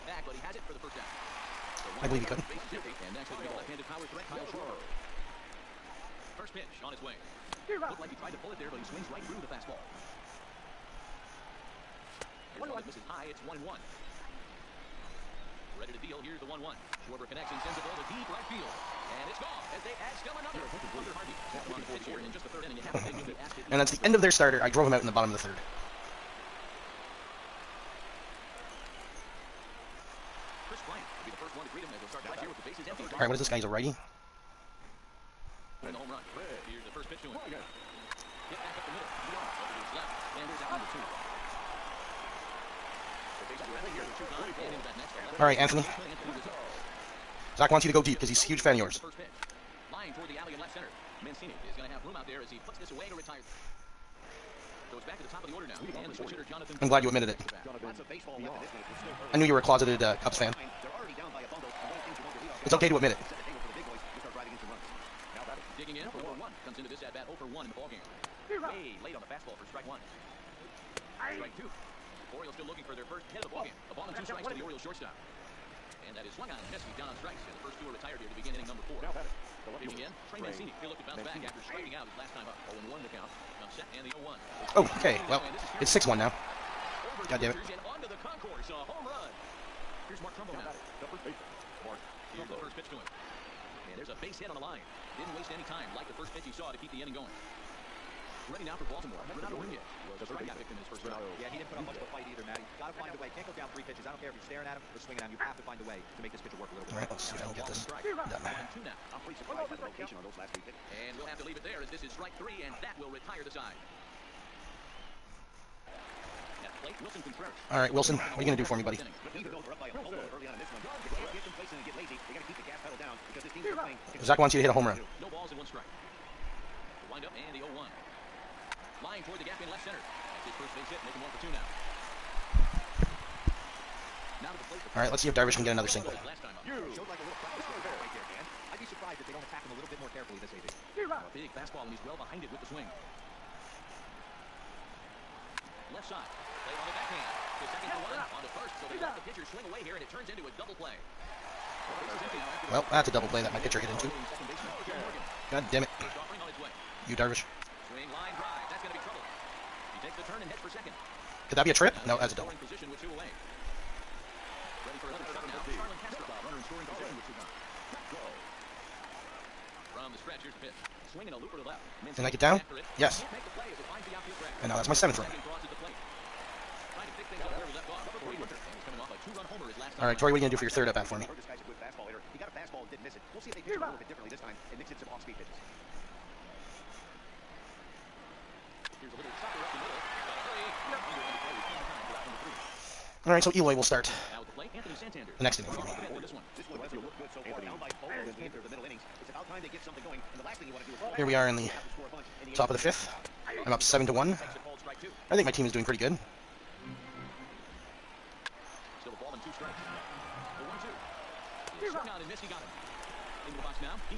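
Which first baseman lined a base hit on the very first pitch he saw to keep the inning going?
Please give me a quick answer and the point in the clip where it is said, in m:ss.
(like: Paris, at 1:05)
Mark Trumbo, at 1:30.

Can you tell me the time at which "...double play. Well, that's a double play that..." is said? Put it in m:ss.
2:30.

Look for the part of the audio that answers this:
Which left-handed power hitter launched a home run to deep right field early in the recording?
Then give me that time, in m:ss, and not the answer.
0:04.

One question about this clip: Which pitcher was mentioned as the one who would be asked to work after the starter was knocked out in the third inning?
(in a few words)
Hunter Harvey.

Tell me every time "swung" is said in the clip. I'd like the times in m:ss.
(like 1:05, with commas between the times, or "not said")
1:16, 3:31.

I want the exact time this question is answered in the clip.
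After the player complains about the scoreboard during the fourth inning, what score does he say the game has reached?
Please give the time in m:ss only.
1:25.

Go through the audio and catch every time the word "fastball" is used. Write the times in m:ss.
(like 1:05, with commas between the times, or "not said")
0:09, 1:09, 2:21, 3:02.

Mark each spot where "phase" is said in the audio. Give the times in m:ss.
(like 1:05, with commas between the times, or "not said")
not said.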